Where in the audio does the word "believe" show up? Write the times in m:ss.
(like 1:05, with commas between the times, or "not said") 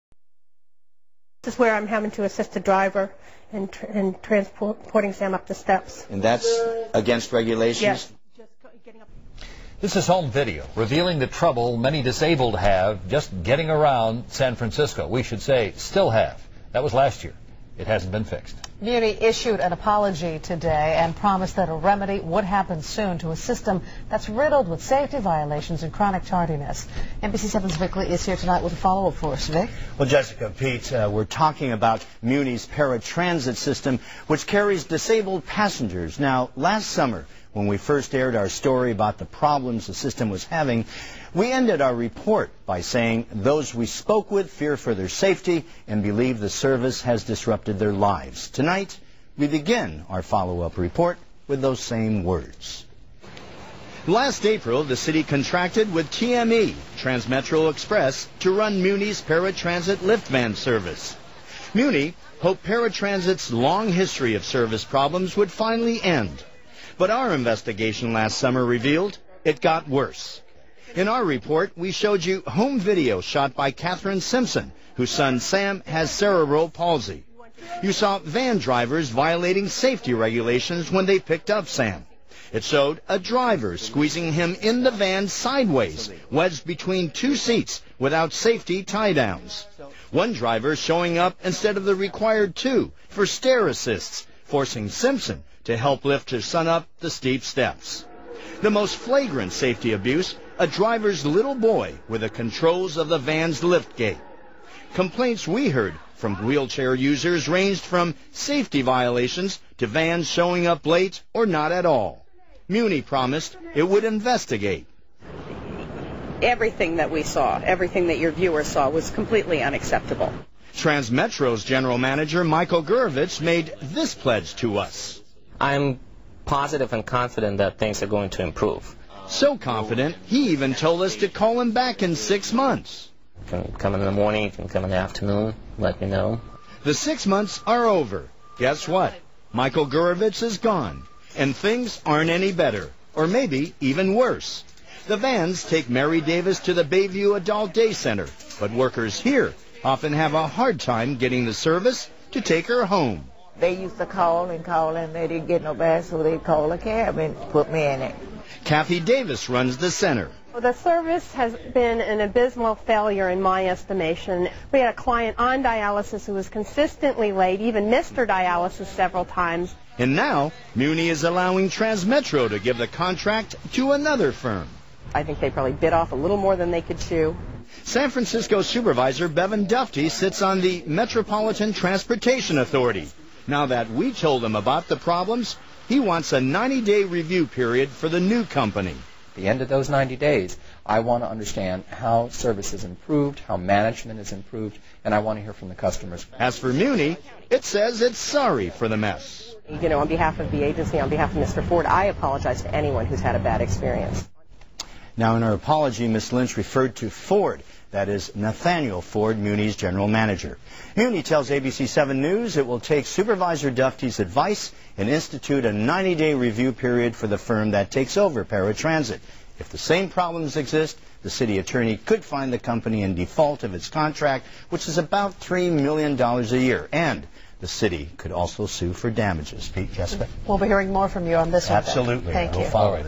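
0:46.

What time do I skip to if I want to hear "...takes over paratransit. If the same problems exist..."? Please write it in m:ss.
3:37.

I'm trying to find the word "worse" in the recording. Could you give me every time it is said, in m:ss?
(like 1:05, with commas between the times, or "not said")
1:09, 2:24.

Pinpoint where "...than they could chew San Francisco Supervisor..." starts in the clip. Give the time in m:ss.
2:56.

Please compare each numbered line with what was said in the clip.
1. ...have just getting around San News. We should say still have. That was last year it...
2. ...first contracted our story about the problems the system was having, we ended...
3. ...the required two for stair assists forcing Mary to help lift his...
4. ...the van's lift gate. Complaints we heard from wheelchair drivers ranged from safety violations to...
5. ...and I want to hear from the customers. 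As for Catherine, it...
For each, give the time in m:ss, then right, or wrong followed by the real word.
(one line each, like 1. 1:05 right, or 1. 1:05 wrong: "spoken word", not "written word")
1. 0:12 wrong: "Francisco", not "News"
2. 0:37 wrong: "aired", not "contracted"
3. 1:31 wrong: "Simpson", not "Mary"
4. 1:43 wrong: "users", not "drivers"
5. 3:15 wrong: "Muni", not "Catherine".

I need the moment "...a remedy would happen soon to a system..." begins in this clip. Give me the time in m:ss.
0:21.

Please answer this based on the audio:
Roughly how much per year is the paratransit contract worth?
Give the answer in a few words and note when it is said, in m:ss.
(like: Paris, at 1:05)
$3 million, at 3:45.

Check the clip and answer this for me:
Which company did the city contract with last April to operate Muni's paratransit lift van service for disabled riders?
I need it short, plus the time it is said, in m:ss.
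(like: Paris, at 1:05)
Transmetro Express, at 0:56.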